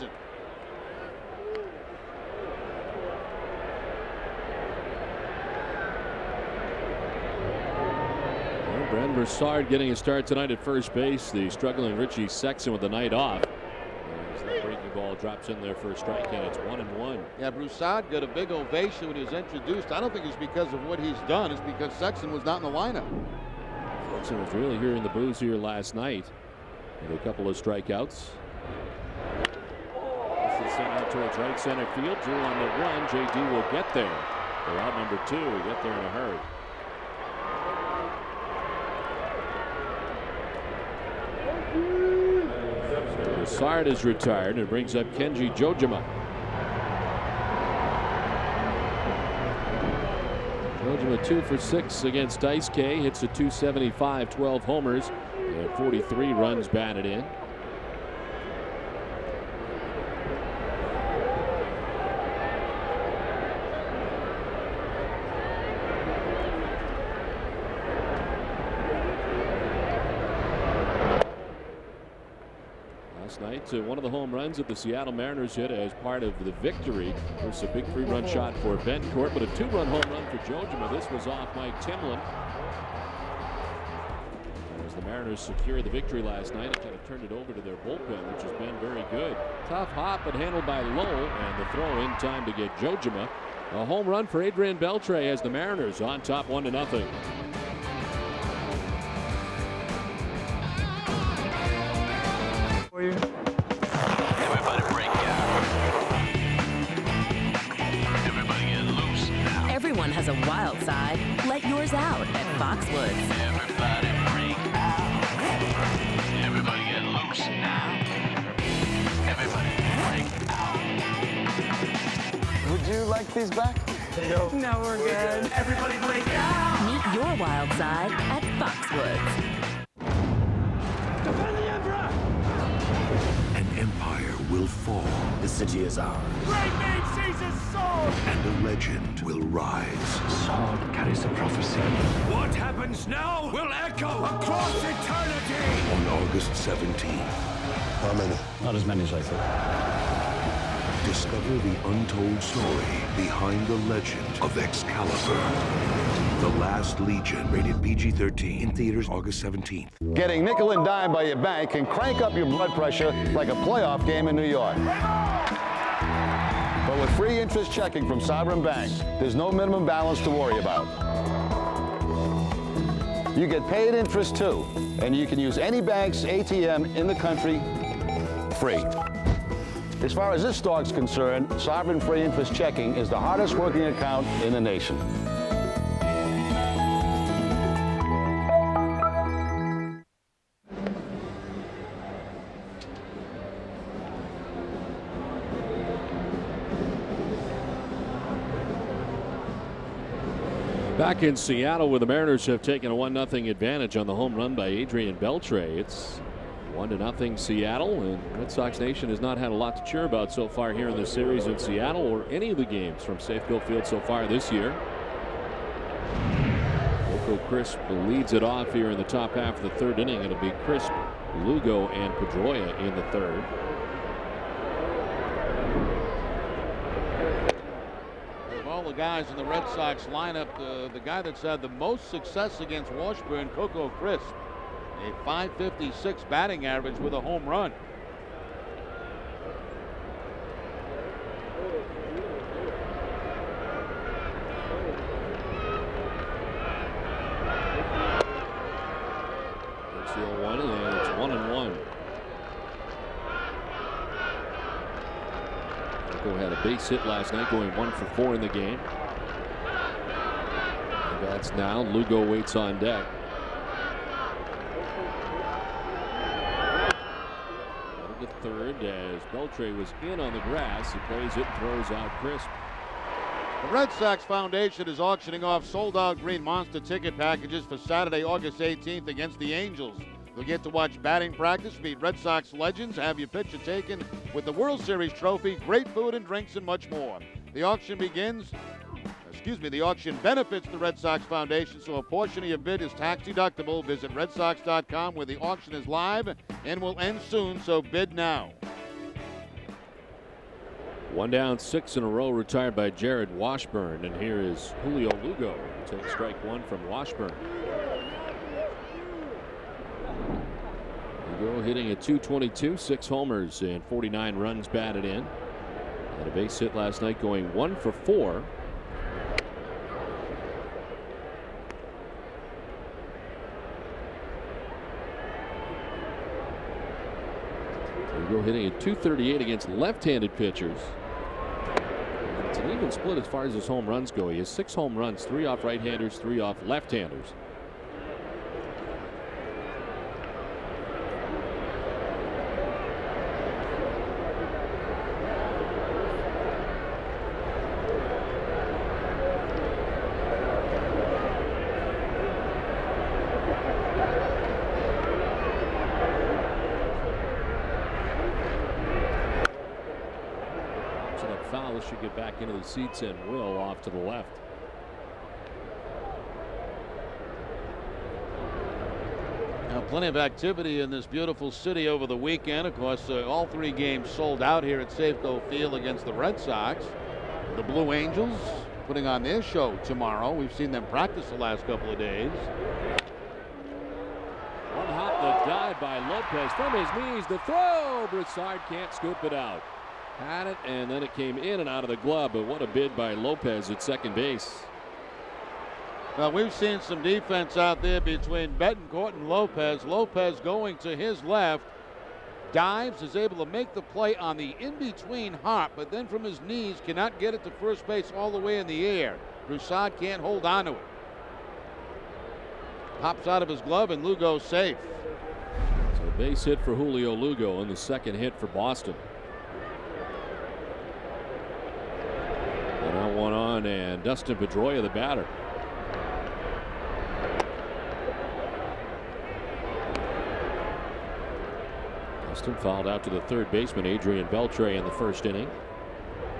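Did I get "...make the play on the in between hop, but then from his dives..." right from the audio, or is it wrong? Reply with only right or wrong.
wrong.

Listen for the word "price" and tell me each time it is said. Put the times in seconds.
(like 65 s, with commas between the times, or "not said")
not said.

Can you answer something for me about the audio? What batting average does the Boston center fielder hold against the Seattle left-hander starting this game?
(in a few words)
.556.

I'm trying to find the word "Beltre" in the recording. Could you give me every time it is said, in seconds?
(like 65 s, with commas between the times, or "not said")
94 s, 205 s, 269 s, 434 s.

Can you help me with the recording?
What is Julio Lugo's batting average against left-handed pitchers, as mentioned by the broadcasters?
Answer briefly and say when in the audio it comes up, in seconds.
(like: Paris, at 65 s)
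.238, at 328 s.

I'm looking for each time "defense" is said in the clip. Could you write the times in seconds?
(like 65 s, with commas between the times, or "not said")
397 s.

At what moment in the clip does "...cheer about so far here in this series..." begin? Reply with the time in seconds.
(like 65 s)
209 s.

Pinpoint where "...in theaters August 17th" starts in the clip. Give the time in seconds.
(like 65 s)
158 s.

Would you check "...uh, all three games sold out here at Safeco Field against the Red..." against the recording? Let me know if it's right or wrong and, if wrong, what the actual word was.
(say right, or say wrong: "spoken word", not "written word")
right.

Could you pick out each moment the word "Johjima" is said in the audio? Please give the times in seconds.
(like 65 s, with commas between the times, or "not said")
45 s, 50 s, 80 s, 92 s.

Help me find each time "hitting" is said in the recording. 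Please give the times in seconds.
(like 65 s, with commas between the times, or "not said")
311 s, 328 s.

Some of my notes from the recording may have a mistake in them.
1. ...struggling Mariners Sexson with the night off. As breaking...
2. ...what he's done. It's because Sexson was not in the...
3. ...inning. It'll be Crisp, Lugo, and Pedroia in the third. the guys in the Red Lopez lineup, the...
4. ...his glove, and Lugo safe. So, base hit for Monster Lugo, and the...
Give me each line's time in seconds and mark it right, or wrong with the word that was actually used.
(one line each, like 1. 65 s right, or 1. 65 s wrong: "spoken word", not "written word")
1. 11 s wrong: "Richie", not "Mariners"
2. 20 s right
3. 220 s wrong: "Sox", not "Lopez"
4. 413 s wrong: "Julio", not "Monster".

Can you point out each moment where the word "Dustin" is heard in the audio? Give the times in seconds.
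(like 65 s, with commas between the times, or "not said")
424 s, 432 s.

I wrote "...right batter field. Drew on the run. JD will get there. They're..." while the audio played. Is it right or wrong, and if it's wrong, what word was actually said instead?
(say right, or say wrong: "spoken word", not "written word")
wrong: "center", not "batter".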